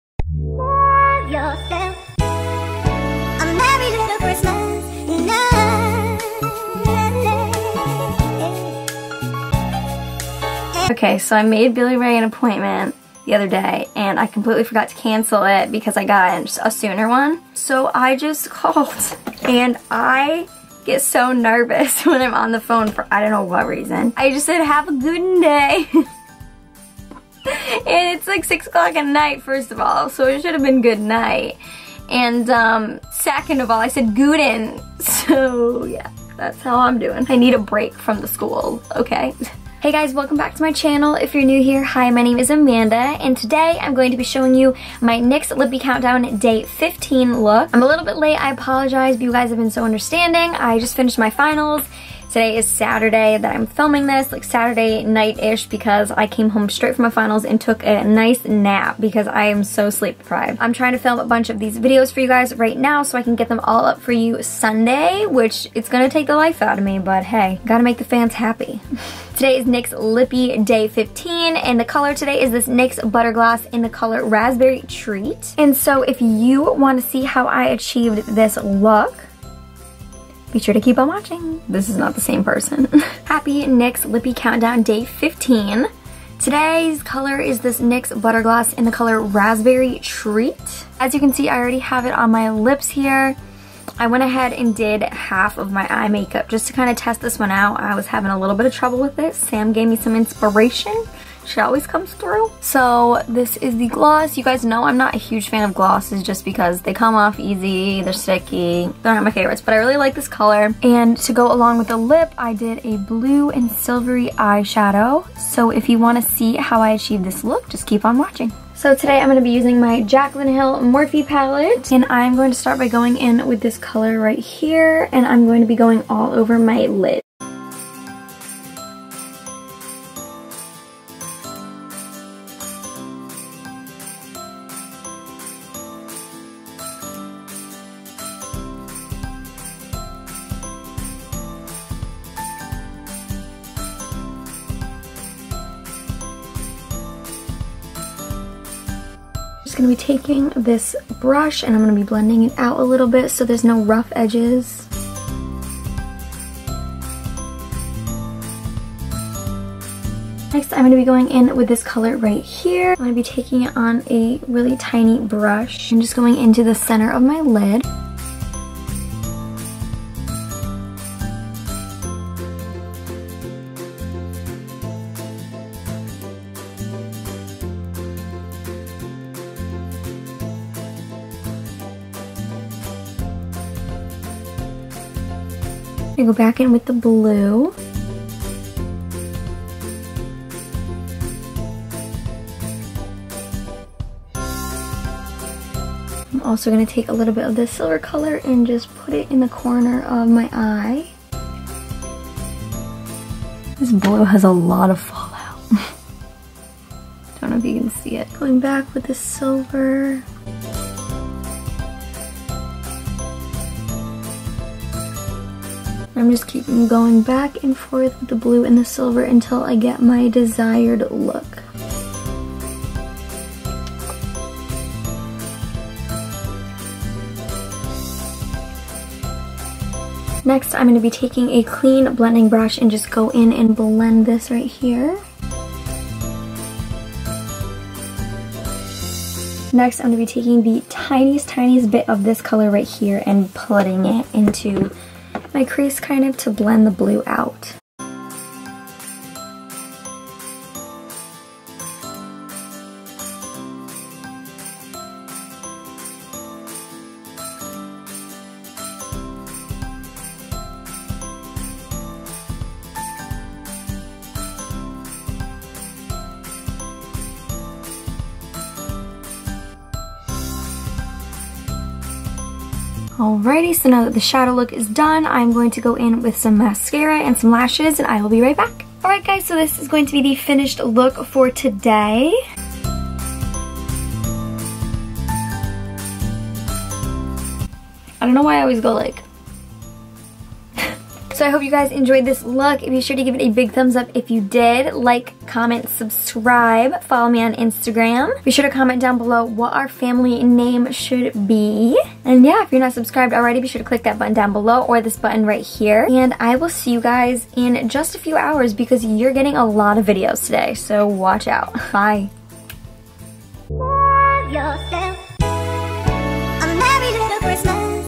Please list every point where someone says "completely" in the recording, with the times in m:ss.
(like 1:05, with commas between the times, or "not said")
0:14.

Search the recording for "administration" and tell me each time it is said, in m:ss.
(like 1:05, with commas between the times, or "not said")
not said.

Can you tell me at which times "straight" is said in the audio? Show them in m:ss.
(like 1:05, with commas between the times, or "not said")
0:56.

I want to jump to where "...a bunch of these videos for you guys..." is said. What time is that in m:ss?
1:01.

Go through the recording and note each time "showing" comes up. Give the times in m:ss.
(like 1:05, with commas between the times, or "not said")
0:44.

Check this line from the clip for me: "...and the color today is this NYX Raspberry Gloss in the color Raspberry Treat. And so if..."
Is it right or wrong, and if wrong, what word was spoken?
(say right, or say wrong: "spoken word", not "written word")
wrong: "Butter", not "Raspberry".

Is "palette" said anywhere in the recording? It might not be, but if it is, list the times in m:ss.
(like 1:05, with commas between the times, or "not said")
2:01.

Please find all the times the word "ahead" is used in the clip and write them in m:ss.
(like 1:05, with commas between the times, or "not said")
1:34.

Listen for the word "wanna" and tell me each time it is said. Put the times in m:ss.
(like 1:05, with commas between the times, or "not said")
1:16, 1:55.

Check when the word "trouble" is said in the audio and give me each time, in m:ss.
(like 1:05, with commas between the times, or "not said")
1:38.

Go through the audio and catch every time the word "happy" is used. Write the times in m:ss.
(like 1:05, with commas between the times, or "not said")
1:08, 1:23.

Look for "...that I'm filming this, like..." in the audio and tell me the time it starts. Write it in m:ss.
0:53.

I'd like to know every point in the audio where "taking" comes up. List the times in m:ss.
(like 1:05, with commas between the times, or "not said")
2:29, 2:43, 3:51, 4:00.